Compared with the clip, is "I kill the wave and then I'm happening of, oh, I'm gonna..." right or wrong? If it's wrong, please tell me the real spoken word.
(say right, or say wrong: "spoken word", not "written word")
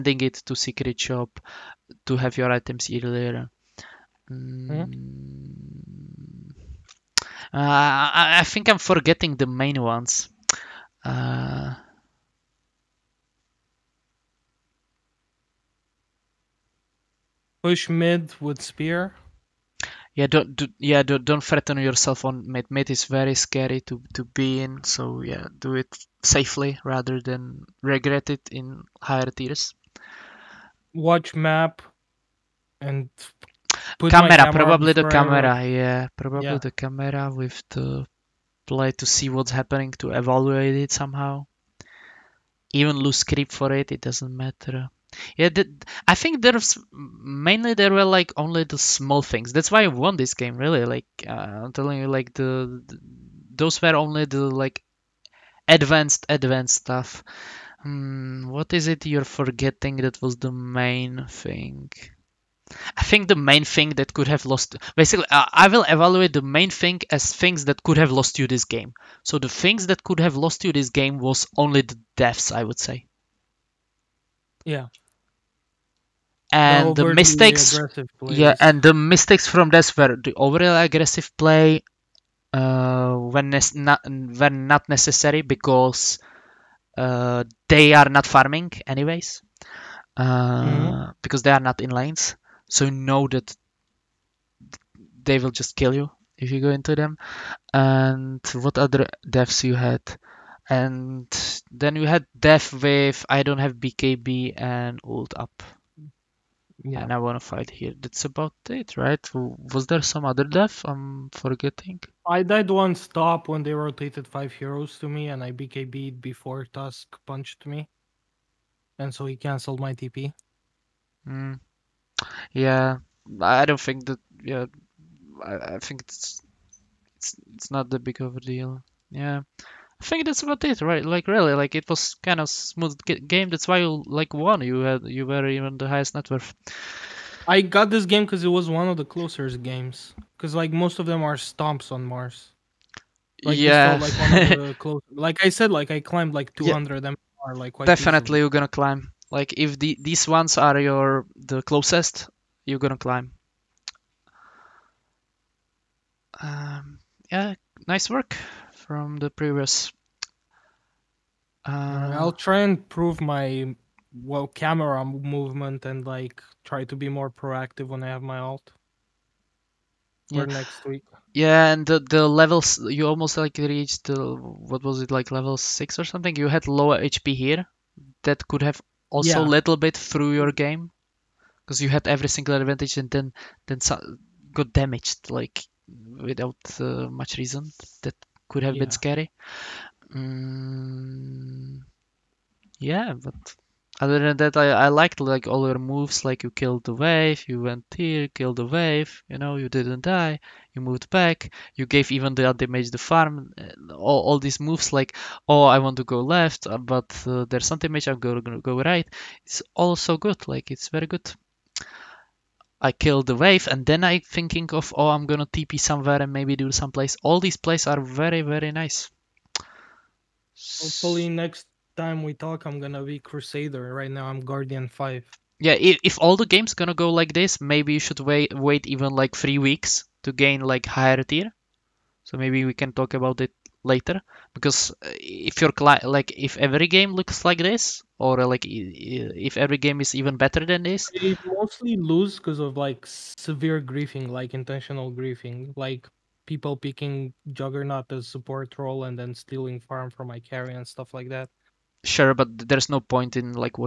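wrong: "thinking", not "happening".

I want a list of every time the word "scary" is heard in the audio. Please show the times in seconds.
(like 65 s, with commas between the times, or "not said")
23 s, 188 s.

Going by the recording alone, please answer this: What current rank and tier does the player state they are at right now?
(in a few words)
Guardian 5.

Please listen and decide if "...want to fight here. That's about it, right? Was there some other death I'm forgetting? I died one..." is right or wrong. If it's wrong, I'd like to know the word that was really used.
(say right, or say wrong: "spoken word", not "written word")
right.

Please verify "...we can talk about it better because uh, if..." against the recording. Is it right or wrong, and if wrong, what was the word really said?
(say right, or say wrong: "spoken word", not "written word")
wrong: "later", not "better".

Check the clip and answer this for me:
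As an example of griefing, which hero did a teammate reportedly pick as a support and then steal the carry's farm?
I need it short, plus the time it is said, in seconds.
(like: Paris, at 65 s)
Juggernaut, at 247 s.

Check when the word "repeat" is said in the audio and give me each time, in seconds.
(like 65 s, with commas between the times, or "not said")
not said.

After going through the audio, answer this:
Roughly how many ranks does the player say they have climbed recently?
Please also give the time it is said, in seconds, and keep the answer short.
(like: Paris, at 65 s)
200, at 146 s.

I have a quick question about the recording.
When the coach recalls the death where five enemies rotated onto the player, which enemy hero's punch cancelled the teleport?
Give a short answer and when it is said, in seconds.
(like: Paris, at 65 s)
Tusk, at 116 s.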